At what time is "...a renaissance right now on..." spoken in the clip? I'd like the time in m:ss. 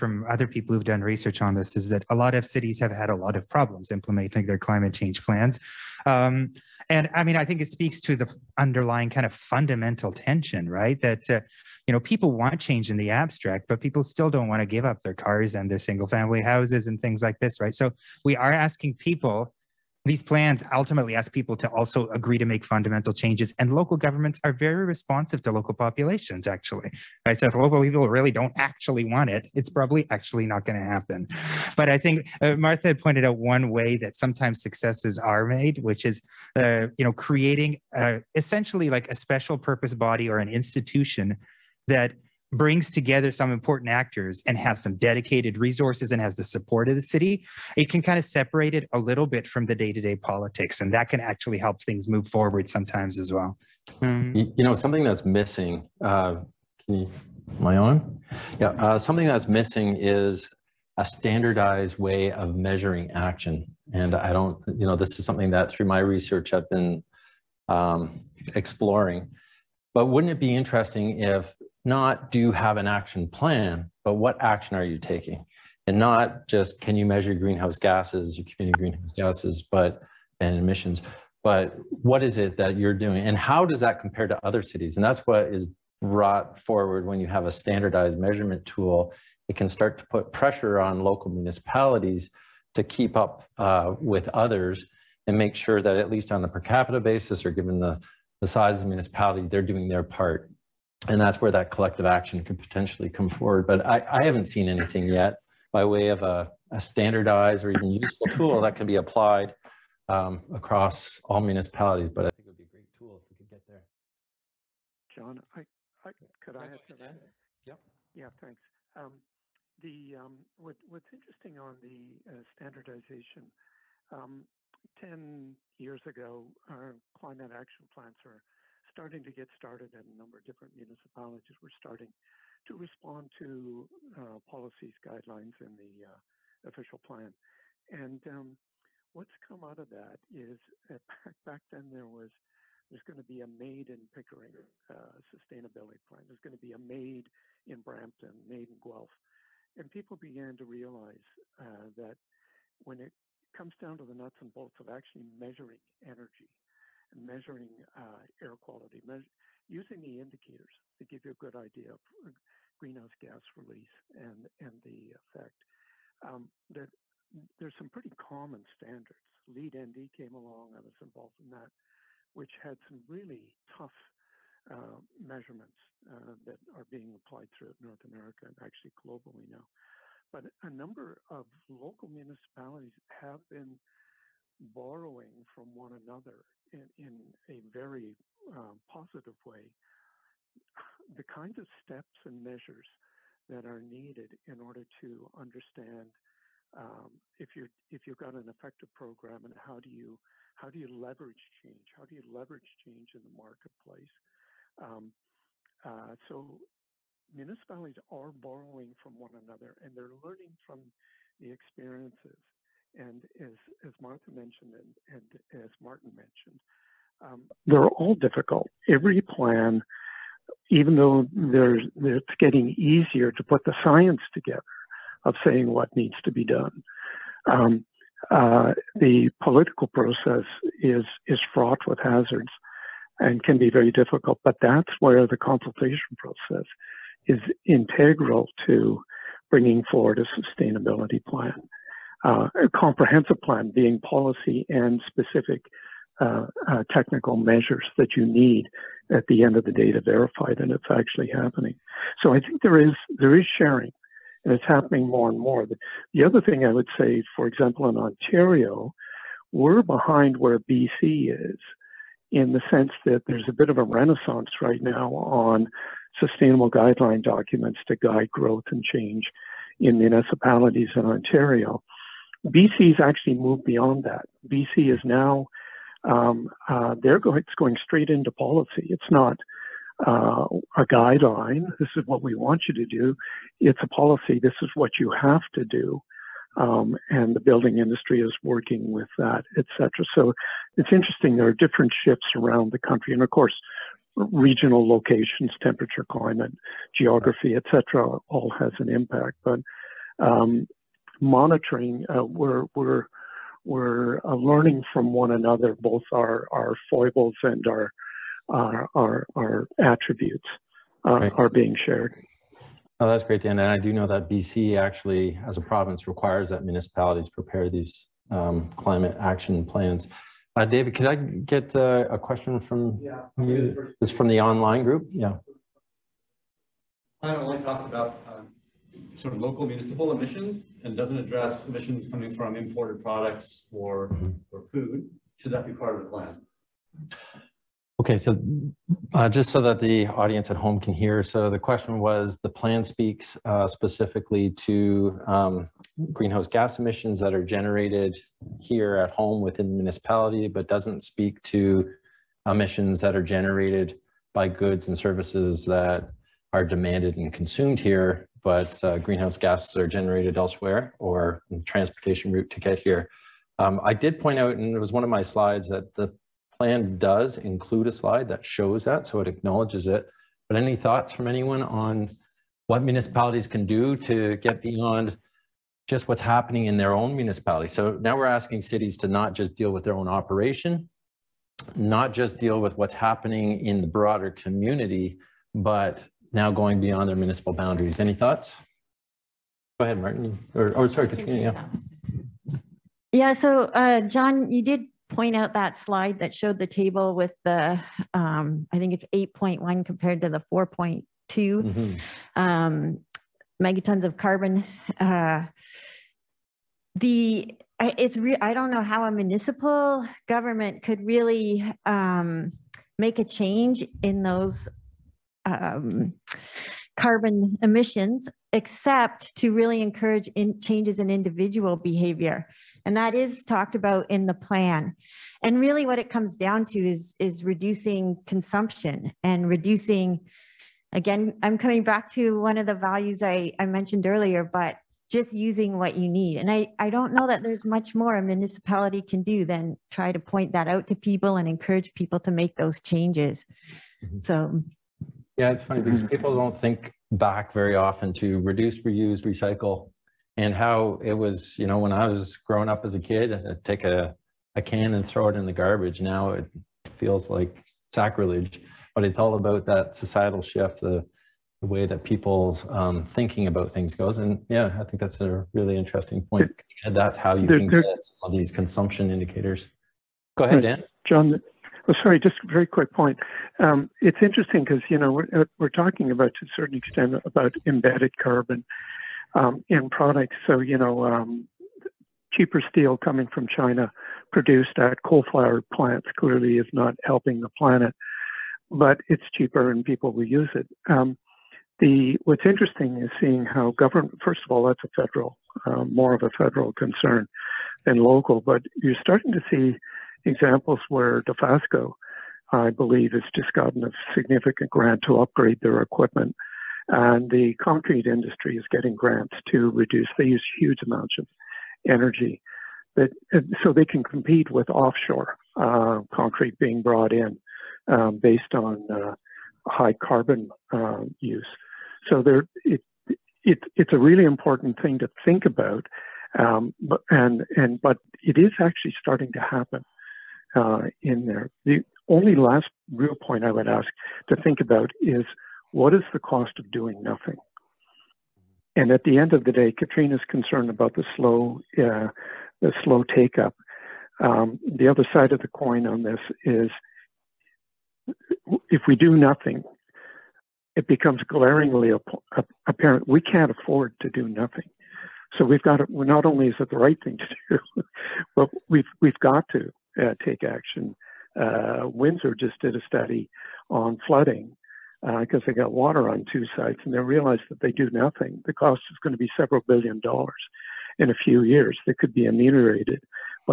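4:23.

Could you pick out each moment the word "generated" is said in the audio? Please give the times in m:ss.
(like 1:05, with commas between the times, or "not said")
5:47, 5:53, 5:59.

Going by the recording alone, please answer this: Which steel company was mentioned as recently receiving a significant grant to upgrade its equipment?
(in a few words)
Dofasco.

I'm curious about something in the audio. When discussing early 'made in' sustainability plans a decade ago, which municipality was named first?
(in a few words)
Pickering.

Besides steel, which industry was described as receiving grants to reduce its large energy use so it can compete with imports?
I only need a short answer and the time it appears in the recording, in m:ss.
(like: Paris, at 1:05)
concrete industry, at 8:27.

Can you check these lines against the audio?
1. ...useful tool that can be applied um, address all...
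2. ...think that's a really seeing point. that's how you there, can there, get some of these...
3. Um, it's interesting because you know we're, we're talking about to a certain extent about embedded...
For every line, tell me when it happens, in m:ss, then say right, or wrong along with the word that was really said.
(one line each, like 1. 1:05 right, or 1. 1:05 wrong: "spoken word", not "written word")
1. 1:47 wrong: "across", not "address"
2. 7:44 wrong: "interesting", not "seeing"
3. 7:53 right.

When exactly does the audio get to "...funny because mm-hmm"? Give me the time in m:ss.
7:25.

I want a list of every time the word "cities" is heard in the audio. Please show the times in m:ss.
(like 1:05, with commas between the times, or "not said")
0:02, 1:24, 6:18.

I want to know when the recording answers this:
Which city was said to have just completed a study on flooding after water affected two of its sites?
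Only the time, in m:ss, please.
9:21.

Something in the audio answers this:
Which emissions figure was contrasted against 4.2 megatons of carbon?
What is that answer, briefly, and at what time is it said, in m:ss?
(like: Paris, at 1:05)
8.1, at 6:39.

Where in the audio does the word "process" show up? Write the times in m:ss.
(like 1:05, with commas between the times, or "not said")
3:49, 3:56.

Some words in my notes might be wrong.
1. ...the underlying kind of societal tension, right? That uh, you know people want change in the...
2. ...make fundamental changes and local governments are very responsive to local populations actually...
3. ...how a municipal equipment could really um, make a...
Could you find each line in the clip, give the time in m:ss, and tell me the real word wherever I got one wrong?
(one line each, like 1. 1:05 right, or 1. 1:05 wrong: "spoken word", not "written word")
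1. 0:08 wrong: "fundamental", not "societal"
2. 0:22 right
3. 6:48 wrong: "government", not "equipment".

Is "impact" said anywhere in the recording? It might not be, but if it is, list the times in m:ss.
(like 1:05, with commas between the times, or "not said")
4:58.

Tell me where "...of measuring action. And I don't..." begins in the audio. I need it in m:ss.
1:02.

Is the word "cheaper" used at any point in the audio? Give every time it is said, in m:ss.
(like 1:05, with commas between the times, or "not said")
8:02, 8:09.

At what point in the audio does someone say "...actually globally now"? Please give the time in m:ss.
2:58.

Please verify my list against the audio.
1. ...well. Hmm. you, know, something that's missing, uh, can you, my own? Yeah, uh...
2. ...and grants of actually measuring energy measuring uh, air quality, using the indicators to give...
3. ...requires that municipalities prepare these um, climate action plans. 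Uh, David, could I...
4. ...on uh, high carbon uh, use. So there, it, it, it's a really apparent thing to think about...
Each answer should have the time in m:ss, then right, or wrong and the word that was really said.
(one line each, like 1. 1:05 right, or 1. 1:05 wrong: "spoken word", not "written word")
1. 0:53 right
2. 2:34 wrong: "bolts", not "grants"
3. 5:16 right
4. 8:38 wrong: "important", not "apparent".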